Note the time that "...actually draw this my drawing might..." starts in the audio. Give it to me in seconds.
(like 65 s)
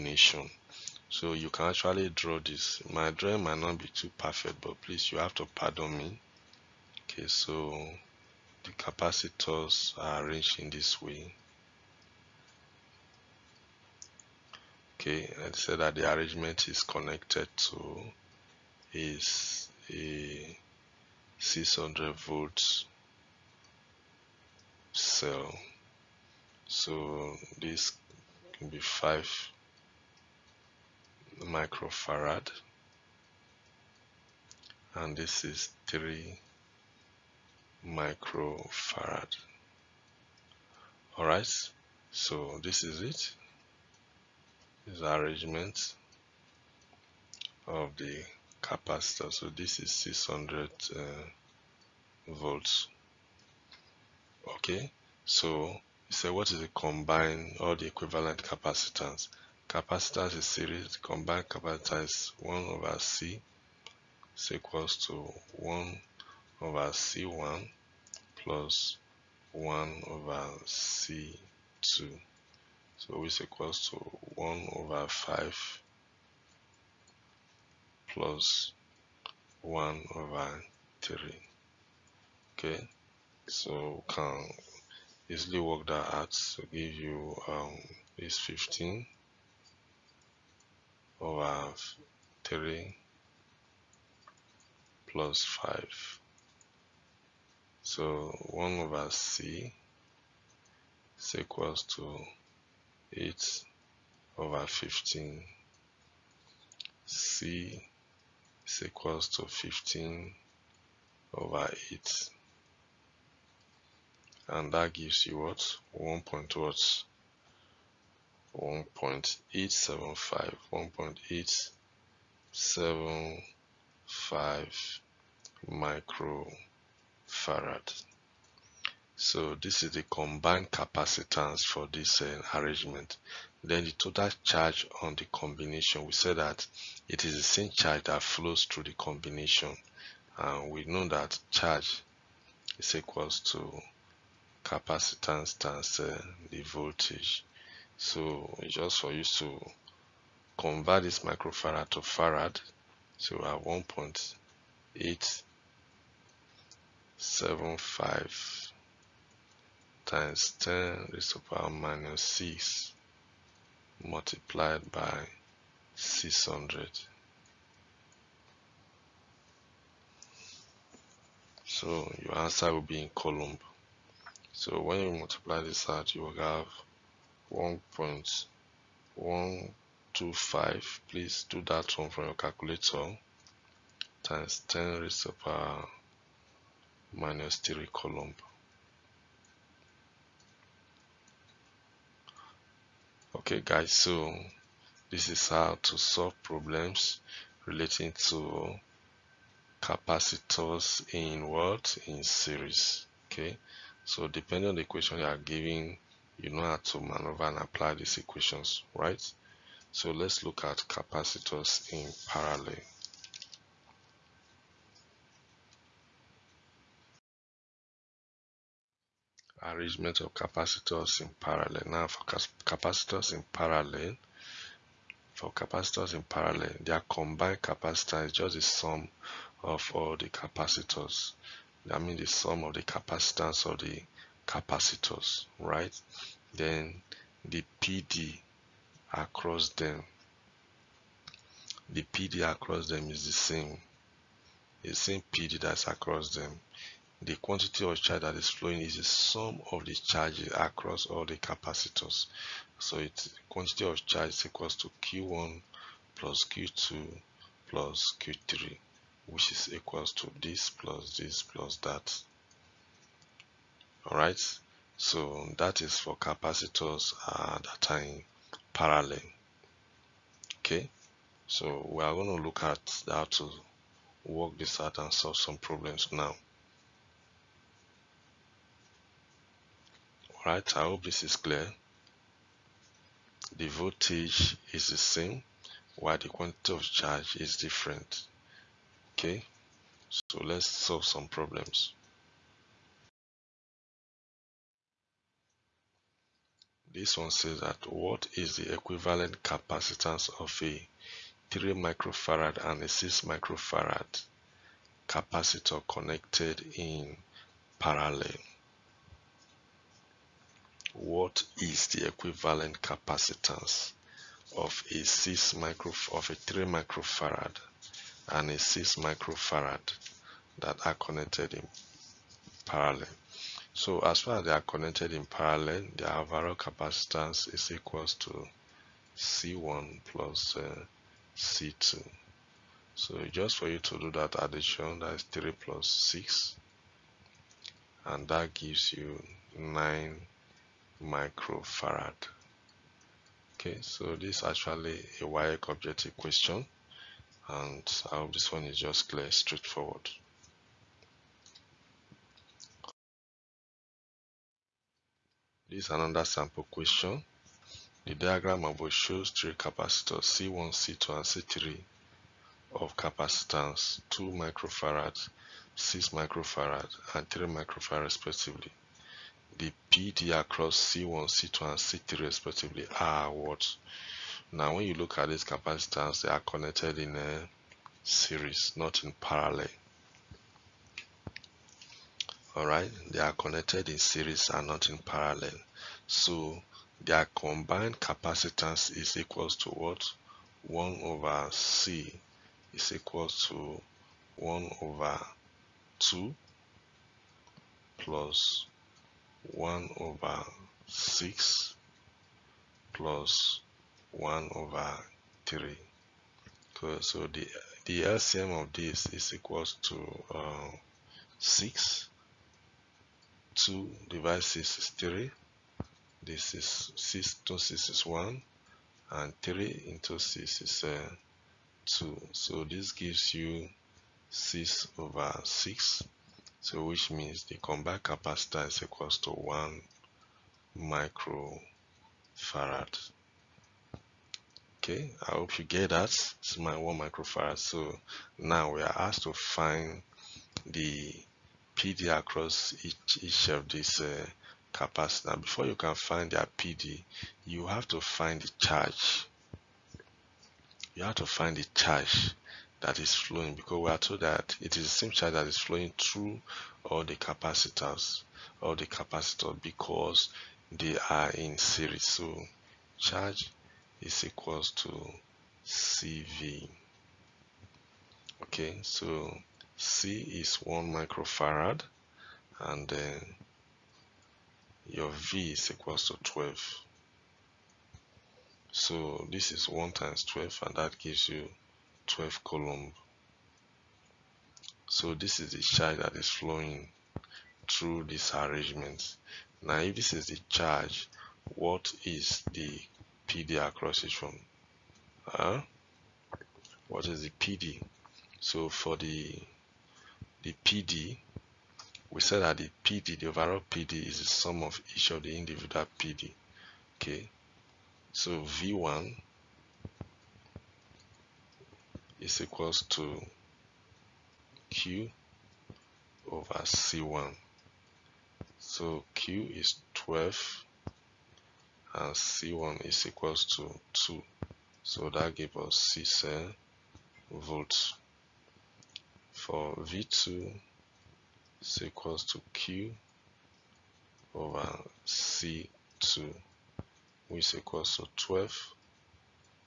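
1 s.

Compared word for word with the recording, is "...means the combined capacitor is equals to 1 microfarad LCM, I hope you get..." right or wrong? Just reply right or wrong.
wrong.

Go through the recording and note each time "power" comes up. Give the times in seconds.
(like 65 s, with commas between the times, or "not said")
161 s, 185 s.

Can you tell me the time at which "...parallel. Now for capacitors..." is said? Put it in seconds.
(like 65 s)
221 s.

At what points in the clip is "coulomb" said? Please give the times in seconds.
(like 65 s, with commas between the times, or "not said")
173 s, 187 s, 482 s.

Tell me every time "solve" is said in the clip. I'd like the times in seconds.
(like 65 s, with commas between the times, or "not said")
195 s, 275 s, 290 s.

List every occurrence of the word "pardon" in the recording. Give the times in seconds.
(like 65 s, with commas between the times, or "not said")
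5 s.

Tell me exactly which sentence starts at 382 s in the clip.
Alright, they are connected in series and not in parallel.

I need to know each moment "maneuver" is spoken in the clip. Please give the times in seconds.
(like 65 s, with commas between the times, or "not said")
206 s.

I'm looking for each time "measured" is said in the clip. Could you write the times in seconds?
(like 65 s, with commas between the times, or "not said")
not said.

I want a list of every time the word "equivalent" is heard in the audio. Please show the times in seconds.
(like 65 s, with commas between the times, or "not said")
57 s, 298 s, 312 s.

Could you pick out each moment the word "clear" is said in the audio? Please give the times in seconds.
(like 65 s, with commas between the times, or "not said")
281 s, 349 s.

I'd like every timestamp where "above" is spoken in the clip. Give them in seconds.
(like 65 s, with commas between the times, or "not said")
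358 s.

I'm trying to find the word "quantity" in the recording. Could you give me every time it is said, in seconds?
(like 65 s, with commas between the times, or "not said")
247 s, 253 s, 286 s.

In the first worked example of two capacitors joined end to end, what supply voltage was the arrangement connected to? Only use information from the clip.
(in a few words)
600 volts.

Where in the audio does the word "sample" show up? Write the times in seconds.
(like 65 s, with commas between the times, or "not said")
356 s.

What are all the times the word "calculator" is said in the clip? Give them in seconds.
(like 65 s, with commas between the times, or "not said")
182 s.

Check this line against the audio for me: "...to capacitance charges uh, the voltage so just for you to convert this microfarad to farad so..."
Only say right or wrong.
wrong.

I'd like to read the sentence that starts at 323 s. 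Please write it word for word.
So as far as they are connected in parallel, the overall capacitance is equals to C1 plus uh, C2.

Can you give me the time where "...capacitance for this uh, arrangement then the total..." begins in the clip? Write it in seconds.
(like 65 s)
130 s.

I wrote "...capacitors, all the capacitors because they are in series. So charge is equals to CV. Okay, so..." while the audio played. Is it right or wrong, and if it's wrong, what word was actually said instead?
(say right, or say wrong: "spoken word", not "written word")
right.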